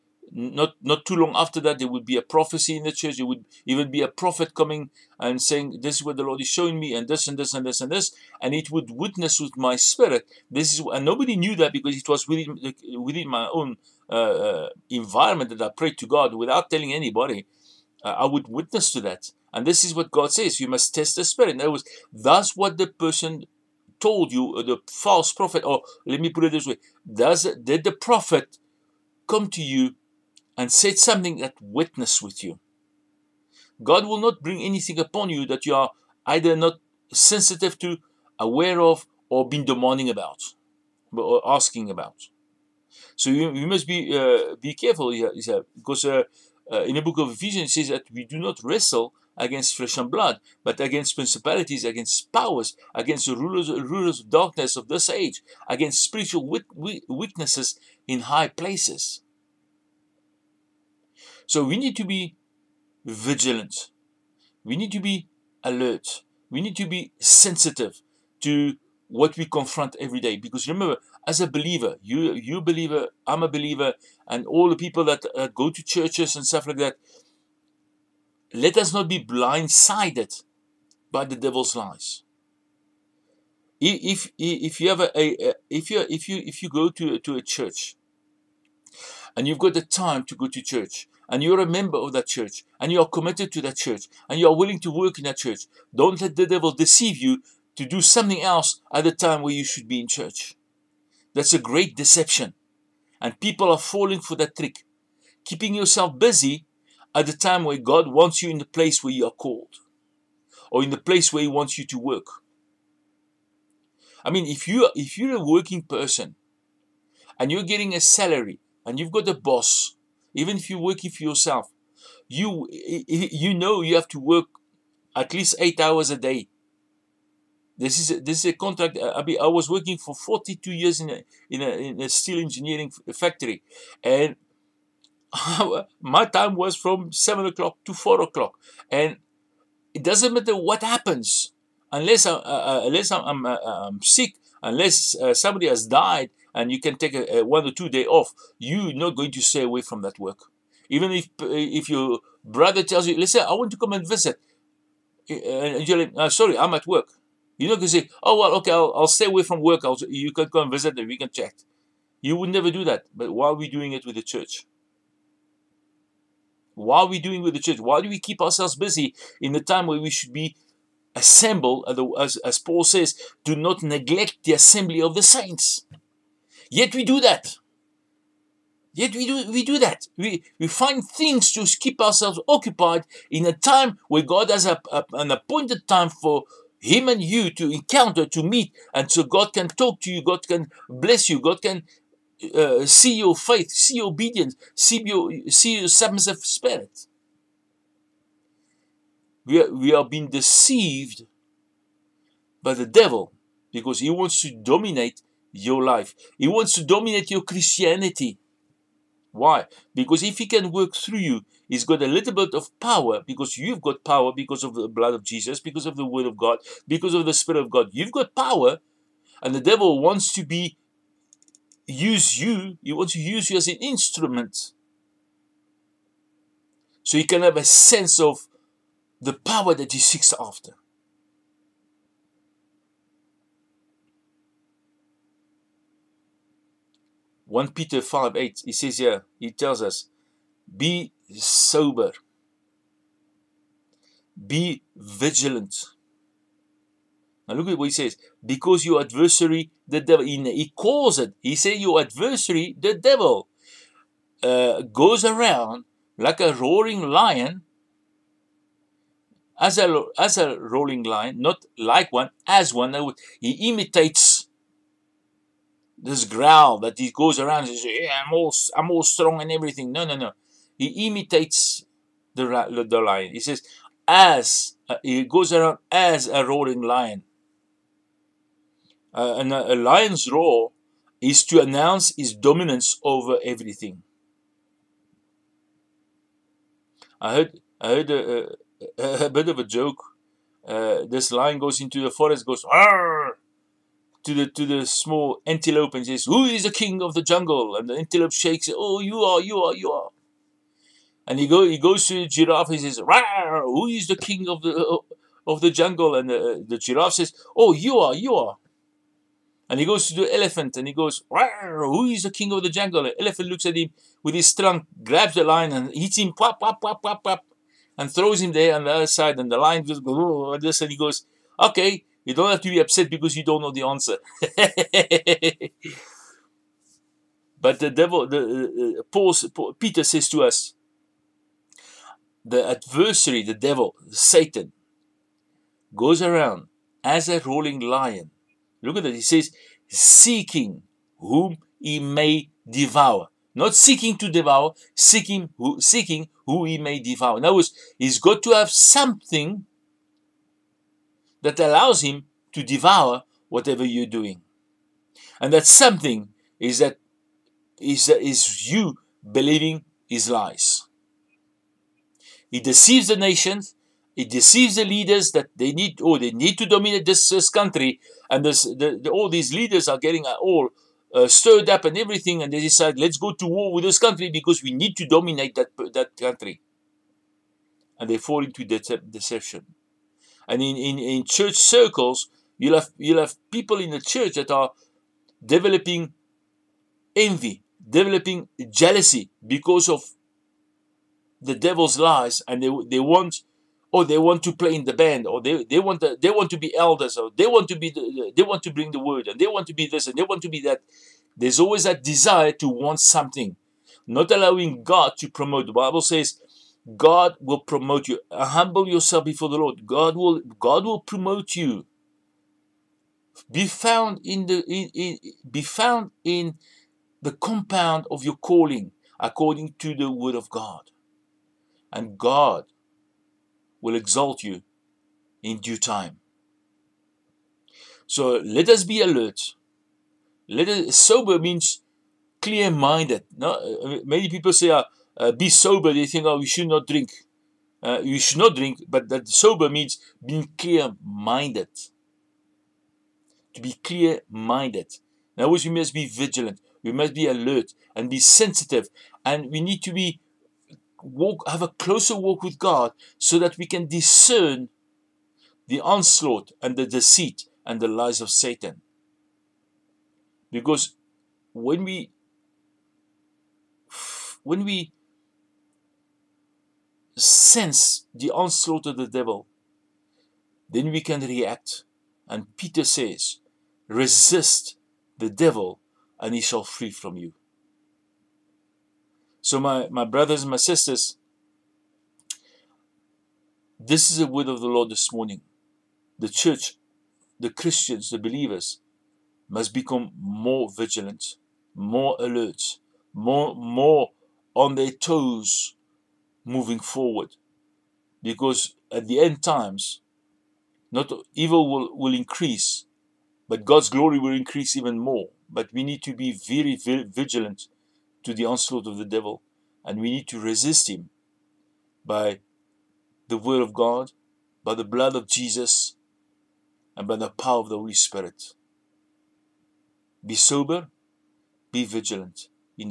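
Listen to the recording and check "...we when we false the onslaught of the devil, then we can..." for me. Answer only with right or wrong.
wrong.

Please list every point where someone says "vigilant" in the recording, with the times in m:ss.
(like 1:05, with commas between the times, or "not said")
1:03, 4:04, 7:26, 8:10, 8:27, 8:41.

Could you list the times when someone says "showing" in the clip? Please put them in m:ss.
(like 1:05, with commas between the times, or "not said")
0:06.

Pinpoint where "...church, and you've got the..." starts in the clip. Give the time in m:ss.
1:27.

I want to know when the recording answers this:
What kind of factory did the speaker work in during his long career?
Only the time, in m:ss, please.
2:12.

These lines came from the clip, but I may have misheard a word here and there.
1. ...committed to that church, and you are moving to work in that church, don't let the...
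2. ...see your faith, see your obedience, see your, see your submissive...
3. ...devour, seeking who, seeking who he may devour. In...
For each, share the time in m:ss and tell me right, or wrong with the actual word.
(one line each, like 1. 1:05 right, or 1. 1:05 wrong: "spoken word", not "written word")
1. 1:33 wrong: "willing", not "moving"
2. 3:12 right
3. 5:44 right.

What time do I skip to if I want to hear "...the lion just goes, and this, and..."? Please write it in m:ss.
5:19.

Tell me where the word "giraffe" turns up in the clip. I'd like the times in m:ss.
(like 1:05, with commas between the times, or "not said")
5:02, 5:06.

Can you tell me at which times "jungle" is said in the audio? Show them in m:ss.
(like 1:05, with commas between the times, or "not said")
4:57, 5:05, 5:12.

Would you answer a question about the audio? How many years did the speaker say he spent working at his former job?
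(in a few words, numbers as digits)
42.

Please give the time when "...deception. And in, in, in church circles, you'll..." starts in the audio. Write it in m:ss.
6:18.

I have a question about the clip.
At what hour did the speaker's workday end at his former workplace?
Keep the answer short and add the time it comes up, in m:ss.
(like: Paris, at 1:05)
4 o'clock, at 2:17.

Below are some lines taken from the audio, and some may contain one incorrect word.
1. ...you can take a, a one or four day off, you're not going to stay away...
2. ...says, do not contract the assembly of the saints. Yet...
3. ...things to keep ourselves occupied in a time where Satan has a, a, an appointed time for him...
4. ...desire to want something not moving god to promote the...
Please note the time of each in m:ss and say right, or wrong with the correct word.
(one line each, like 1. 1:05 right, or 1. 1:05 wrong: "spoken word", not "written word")
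1. 2:26 wrong: "two", not "four"
2. 2:52 wrong: "neglect", not "contract"
3. 3:01 wrong: "God", not "Satan"
4. 6:42 wrong: "allowing", not "moving".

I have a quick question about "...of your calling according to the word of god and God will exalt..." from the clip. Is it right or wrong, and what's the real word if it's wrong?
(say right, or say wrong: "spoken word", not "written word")
right.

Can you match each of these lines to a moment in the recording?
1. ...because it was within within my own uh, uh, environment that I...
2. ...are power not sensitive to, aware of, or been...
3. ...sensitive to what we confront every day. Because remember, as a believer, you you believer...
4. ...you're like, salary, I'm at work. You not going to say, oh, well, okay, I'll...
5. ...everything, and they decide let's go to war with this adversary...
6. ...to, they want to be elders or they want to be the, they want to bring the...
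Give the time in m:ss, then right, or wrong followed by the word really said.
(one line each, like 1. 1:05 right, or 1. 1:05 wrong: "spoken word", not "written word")
1. 0:11 right
2. 0:35 wrong: "either", not "power"
3. 1:07 right
4. 2:35 wrong: "sorry", not "salary"
5. 6:11 wrong: "country", not "adversary"
6. 6:35 right.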